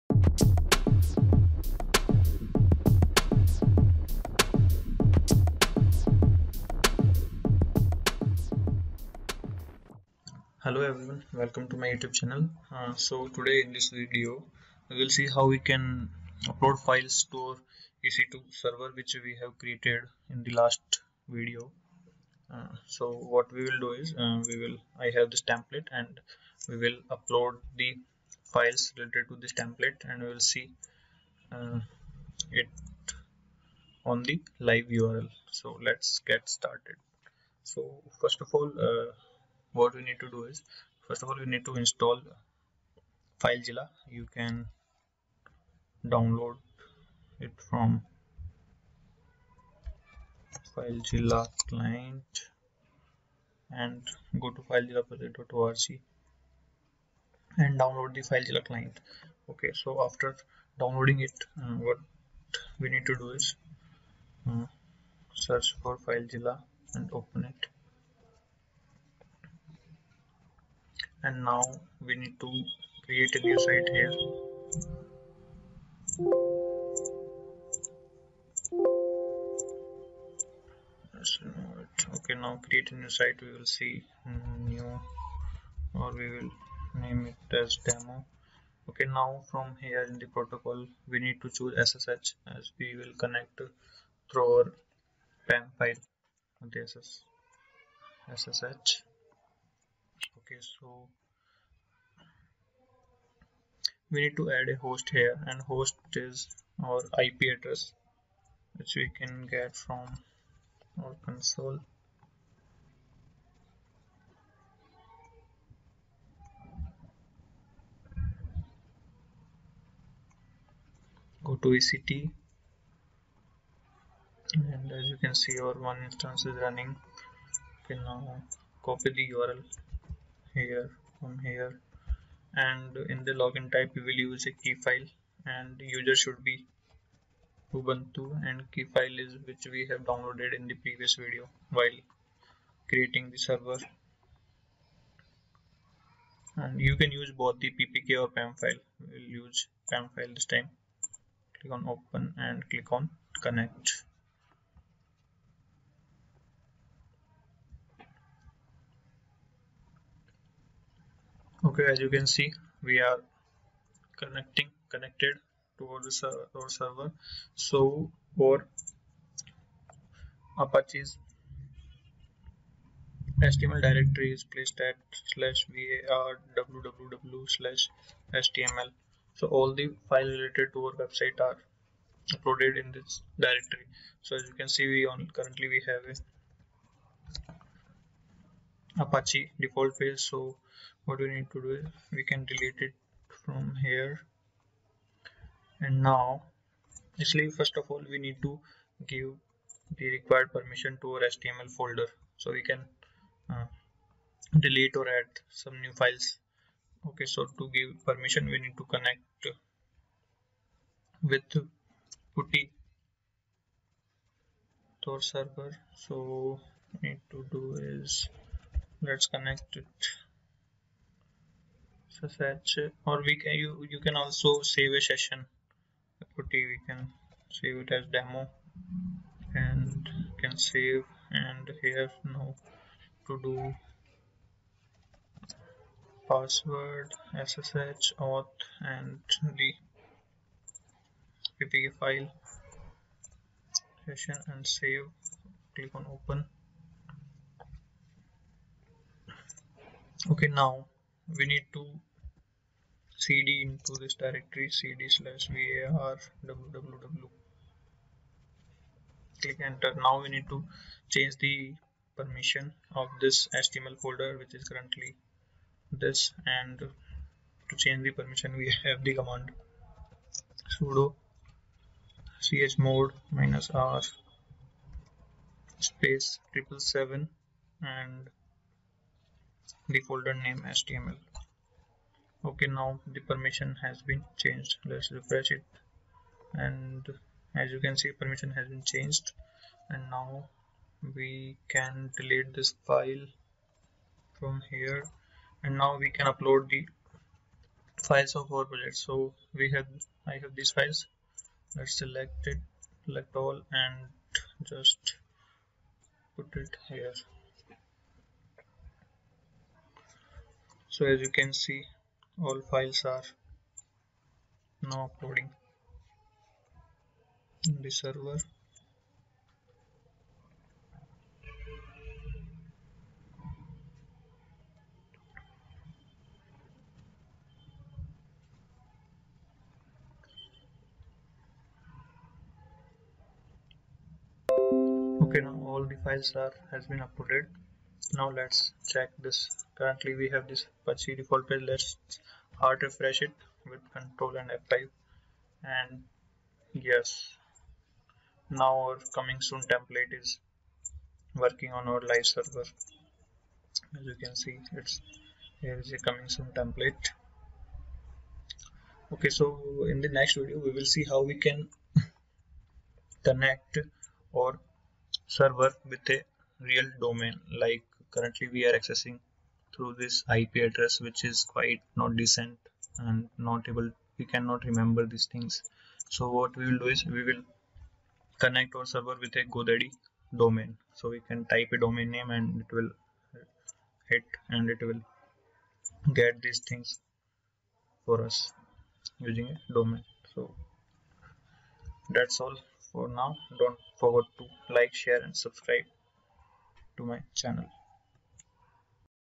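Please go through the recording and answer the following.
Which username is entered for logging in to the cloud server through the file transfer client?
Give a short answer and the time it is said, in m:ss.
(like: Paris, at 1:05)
ubuntu, at 2:17.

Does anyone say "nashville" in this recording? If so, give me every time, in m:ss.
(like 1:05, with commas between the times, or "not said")
not said.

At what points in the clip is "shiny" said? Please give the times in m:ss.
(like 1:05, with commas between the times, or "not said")
not said.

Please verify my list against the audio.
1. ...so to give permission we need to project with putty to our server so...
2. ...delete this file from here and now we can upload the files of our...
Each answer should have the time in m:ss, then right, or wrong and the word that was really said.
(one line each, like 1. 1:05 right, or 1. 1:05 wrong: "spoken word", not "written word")
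1. 3:27 wrong: "connect", not "project"
2. 4:52 right.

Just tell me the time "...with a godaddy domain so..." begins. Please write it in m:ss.
6:19.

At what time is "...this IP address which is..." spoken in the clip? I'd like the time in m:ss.
6:10.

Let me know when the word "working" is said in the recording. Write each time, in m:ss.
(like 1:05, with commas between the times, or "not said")
5:51.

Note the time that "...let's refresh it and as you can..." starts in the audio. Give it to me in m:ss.
4:44.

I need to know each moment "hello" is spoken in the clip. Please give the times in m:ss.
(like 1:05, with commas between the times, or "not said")
0:10.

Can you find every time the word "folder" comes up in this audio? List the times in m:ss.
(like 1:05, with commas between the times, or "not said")
3:21, 4:24, 4:40.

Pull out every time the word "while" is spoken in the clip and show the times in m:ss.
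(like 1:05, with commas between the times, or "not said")
2:21.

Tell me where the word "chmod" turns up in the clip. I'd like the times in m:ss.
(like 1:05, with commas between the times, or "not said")
4:32.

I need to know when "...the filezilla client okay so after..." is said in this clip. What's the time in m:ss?
0:58.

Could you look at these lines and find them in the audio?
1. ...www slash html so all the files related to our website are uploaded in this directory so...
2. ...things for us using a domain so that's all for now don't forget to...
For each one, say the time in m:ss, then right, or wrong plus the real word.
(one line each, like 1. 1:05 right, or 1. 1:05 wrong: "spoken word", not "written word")
1. 2:56 right
2. 6:26 right.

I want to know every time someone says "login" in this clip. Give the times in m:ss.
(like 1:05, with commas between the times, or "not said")
2:13.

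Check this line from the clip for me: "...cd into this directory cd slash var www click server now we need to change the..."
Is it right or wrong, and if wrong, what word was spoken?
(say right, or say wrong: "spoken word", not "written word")
wrong: "enter", not "server".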